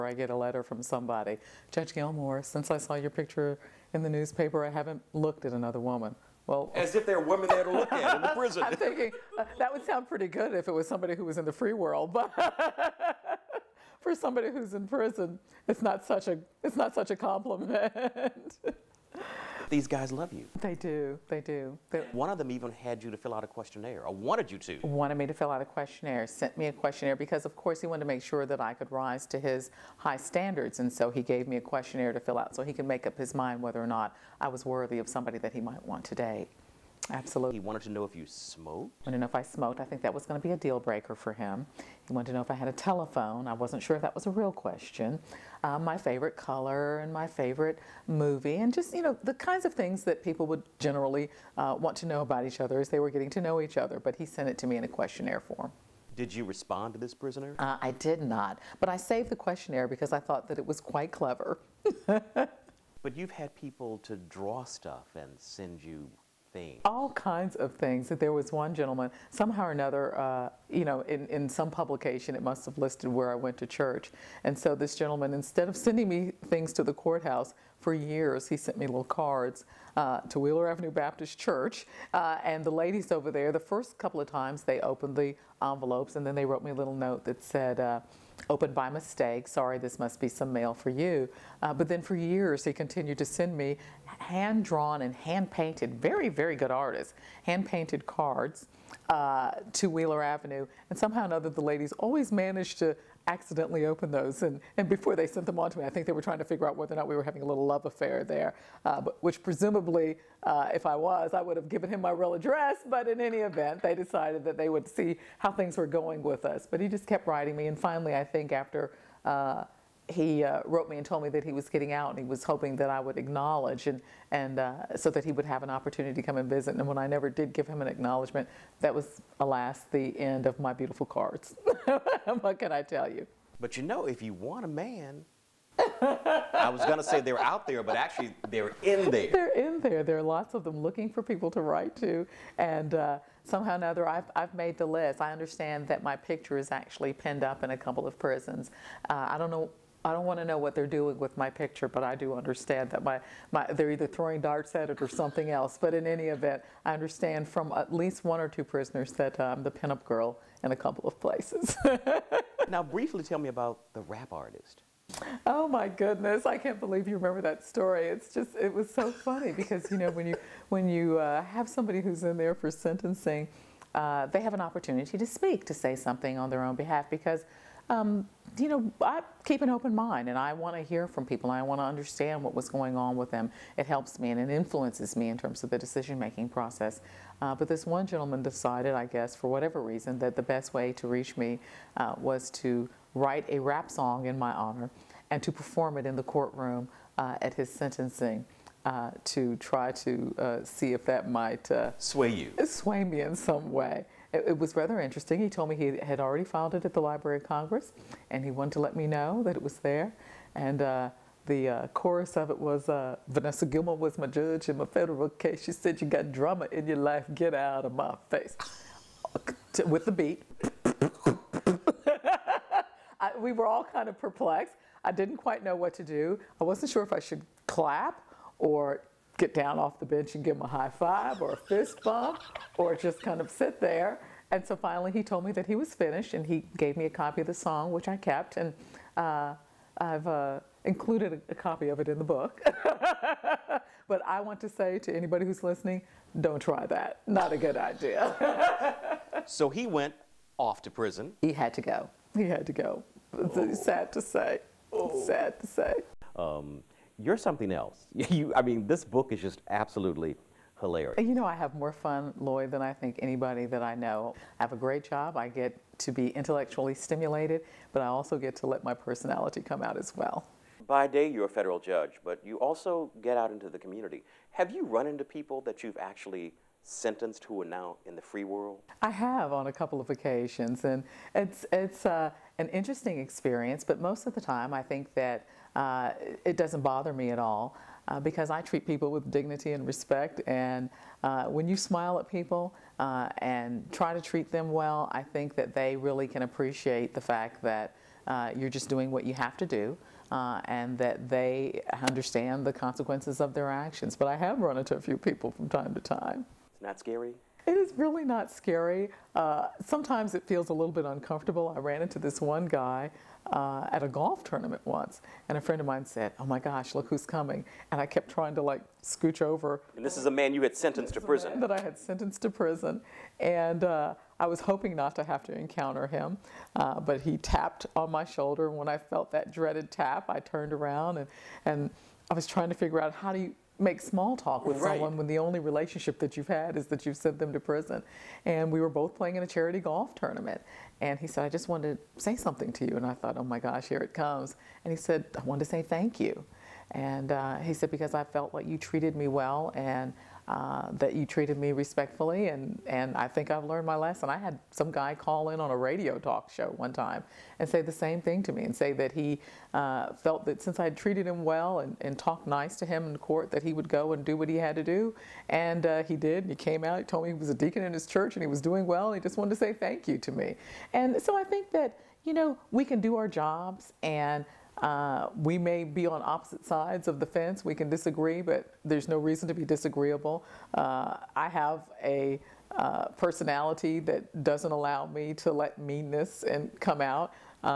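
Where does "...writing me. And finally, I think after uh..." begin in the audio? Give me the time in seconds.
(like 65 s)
117 s.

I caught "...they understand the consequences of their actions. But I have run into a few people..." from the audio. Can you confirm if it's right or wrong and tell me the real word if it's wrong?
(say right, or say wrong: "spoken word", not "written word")
right.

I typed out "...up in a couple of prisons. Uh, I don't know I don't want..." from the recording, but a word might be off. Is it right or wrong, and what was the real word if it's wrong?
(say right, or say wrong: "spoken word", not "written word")
right.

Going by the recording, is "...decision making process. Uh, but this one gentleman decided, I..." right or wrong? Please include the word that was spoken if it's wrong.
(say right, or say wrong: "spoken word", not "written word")
right.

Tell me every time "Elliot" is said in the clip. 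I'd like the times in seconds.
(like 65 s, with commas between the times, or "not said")
not said.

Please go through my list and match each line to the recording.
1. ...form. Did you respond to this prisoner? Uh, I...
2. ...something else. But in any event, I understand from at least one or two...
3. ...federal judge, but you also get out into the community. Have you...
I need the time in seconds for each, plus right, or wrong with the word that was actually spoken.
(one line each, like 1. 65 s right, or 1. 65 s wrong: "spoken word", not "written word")
1. 55 s right
2. 155 s right
3. 271 s right.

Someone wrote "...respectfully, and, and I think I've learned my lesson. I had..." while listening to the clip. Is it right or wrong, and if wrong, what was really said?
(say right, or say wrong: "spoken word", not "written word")
right.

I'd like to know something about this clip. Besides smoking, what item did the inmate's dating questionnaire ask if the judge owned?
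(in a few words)
A telephone.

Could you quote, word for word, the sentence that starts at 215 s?
She said, You got drama in your life, get out of my face.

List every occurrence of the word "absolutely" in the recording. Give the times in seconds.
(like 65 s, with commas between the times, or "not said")
37 s, 259 s.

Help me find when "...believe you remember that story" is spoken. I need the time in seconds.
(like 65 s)
166 s.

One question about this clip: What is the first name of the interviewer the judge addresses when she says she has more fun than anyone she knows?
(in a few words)
Lloyd.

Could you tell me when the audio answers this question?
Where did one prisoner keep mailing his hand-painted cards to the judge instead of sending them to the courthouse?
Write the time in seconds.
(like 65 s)
80 s.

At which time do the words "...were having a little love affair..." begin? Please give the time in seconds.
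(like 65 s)
107 s.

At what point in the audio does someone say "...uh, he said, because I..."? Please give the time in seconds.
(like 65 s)
347 s.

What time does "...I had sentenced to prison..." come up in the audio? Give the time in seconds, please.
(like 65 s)
321 s.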